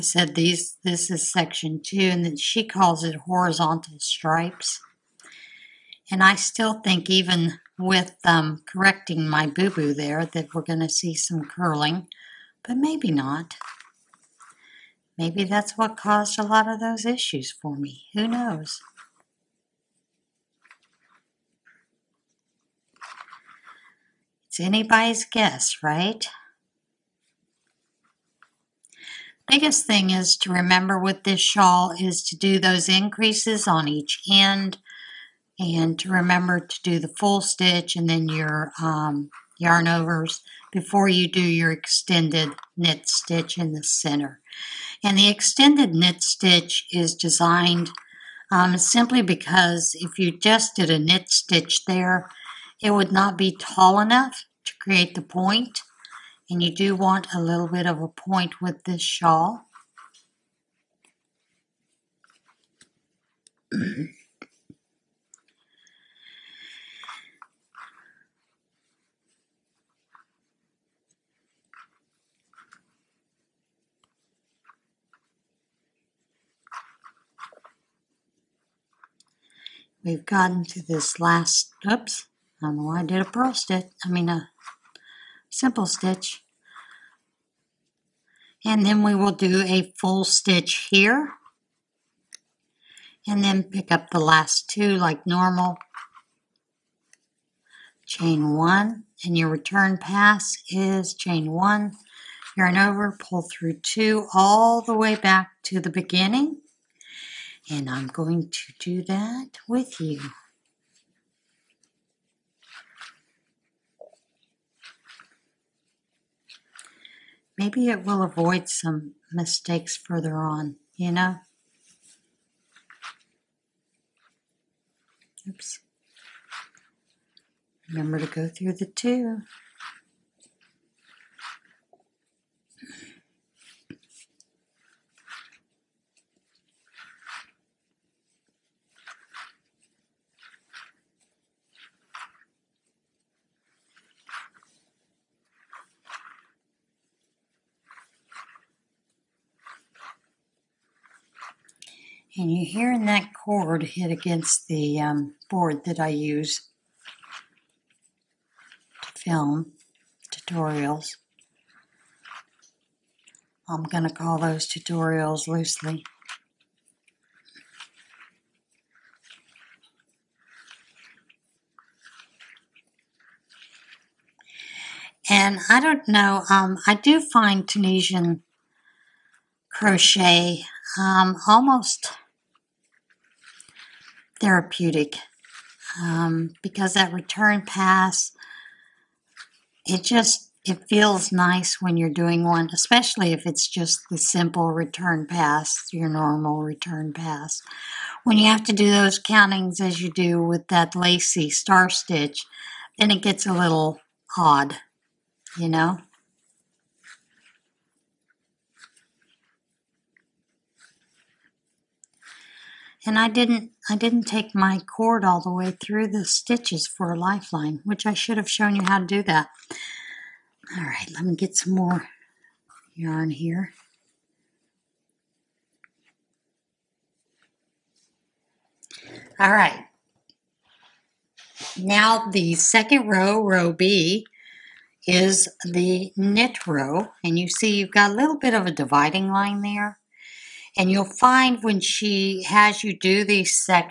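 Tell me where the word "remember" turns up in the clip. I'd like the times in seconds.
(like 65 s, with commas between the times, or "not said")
30 s, 36 s, 127 s.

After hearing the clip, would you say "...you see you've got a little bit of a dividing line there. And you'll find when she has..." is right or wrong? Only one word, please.
right.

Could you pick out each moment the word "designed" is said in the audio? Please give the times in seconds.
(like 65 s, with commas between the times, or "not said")
47 s.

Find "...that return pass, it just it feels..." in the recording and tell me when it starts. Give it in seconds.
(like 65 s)
186 s.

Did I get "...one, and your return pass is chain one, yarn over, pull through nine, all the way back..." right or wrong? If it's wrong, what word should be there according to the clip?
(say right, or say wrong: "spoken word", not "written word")
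wrong: "two", not "nine".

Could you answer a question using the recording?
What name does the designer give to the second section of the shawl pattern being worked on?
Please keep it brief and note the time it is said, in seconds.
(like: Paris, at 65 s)
horizontal stripes, at 3 s.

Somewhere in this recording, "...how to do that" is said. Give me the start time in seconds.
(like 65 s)
218 s.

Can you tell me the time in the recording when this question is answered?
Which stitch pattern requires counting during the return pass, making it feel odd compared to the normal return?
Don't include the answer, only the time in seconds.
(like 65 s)
200 s.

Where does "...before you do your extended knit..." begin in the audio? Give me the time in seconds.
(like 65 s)
40 s.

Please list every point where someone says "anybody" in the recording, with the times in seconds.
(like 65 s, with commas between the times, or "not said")
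24 s.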